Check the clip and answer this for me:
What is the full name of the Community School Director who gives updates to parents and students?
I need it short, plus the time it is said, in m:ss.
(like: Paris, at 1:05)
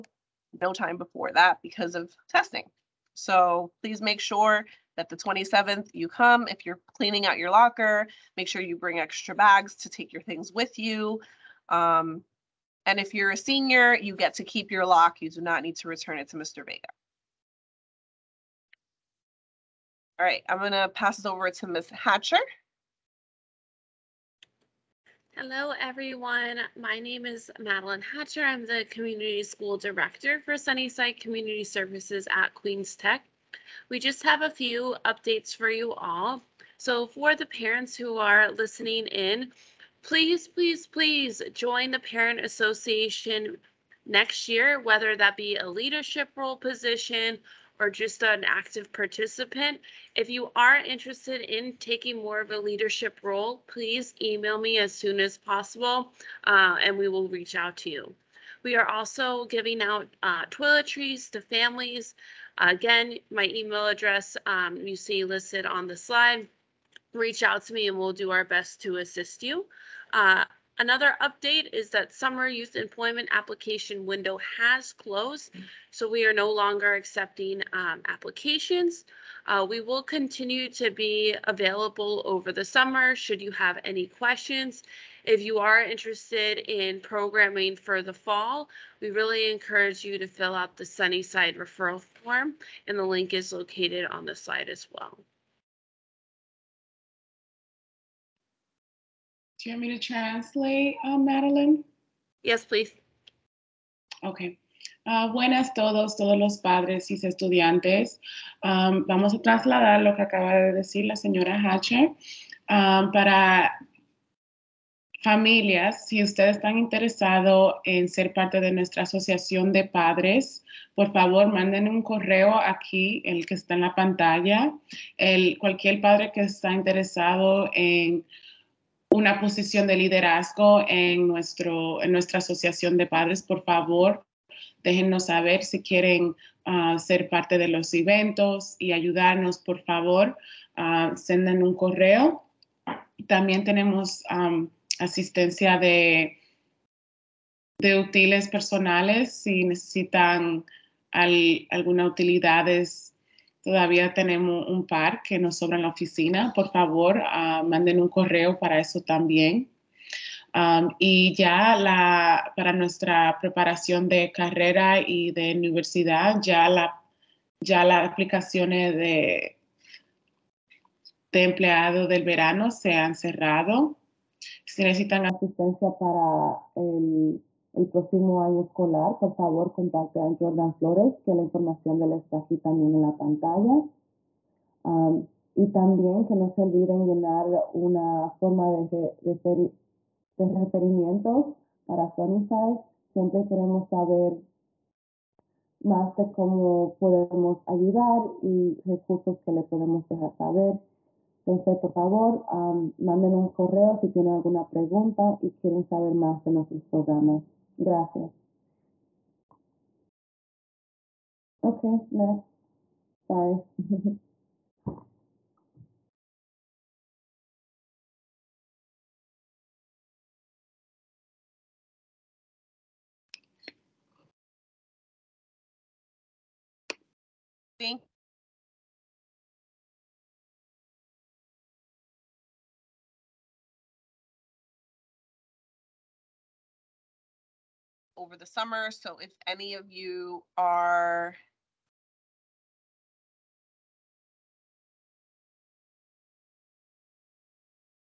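Madeline Hatcher, at 0:27.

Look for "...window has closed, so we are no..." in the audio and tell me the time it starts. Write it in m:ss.
1:14.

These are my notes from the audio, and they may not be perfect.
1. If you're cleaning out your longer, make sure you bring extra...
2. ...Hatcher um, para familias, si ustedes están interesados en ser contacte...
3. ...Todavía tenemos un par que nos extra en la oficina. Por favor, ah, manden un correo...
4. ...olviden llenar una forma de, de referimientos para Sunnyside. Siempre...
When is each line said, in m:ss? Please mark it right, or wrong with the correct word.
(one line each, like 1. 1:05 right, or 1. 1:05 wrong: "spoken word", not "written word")
1. 0:06 wrong: "locker", not "longer"
2. 1:51 wrong: "parte", not "contacte"
3. 2:33 wrong: "sobra", not "extra"
4. 3:06 right.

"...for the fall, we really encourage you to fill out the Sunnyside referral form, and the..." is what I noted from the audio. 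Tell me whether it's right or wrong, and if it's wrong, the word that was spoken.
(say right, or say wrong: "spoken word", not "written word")
right.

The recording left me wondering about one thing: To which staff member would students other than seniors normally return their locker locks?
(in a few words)
Mr. Vega.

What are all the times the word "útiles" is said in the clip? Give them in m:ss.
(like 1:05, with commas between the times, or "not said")
2:27.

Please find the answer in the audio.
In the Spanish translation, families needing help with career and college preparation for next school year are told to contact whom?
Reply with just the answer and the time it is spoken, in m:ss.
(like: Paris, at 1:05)
Jordan Flores, at 3:00.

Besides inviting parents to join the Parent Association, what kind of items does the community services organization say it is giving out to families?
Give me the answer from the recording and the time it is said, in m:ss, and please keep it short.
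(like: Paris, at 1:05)
toiletries, at 1:00.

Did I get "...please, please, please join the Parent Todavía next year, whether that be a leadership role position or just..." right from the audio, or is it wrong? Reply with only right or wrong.
wrong.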